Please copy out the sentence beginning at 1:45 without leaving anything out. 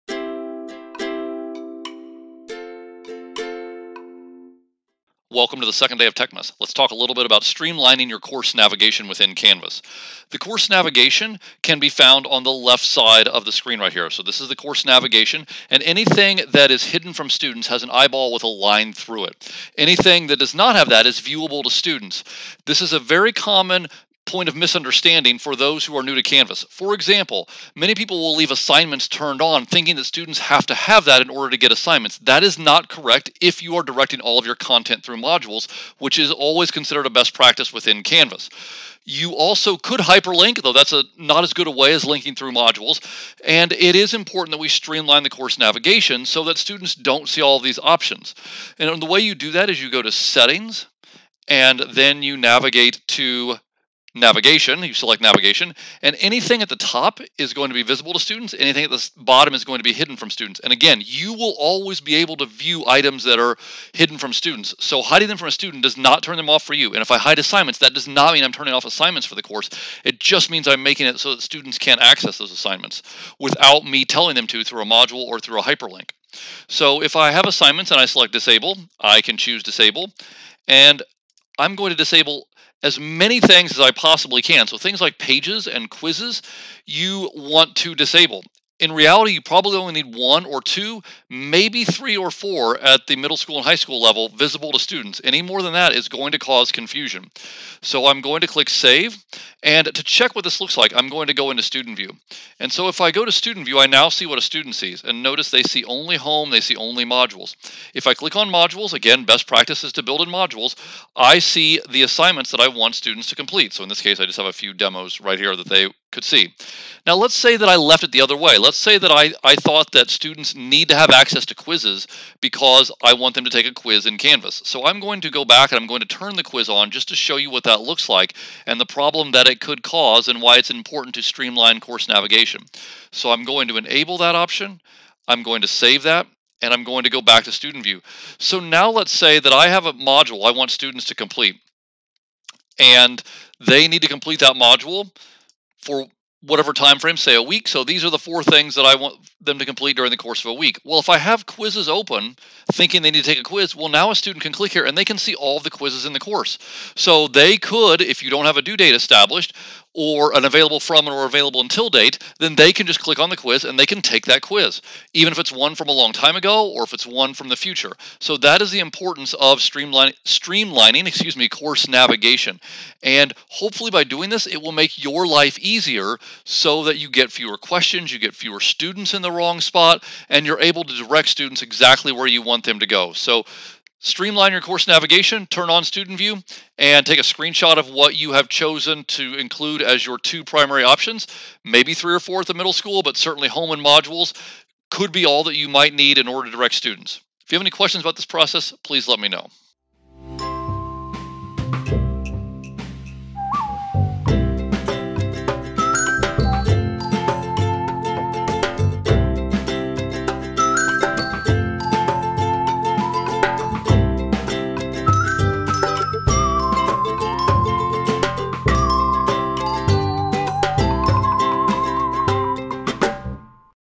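And notice they see only home, they see only modules.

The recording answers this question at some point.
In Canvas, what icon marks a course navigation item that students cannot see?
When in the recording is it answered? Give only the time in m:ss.
0:17.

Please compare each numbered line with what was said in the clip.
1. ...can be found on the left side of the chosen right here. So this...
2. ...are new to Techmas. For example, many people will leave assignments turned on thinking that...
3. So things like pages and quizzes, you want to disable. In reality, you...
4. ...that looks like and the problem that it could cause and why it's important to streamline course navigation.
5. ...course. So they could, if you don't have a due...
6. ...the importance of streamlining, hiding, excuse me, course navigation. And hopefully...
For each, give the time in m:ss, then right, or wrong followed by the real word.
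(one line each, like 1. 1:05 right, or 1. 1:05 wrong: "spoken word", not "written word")
1. 0:11 wrong: "screen", not "chosen"
2. 0:25 wrong: "Canvas", not "Techmas"
3. 1:24 right
4. 2:07 right
5. 2:36 right
6. 2:48 wrong: "streamlining", not "hiding".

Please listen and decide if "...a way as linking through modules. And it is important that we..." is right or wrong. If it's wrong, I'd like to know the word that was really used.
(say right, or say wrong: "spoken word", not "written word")
right.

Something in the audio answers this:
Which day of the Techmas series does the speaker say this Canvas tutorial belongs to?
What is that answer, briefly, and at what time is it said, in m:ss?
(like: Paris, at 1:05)
Second day, at 0:05.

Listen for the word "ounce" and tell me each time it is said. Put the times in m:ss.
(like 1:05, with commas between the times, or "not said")
not said.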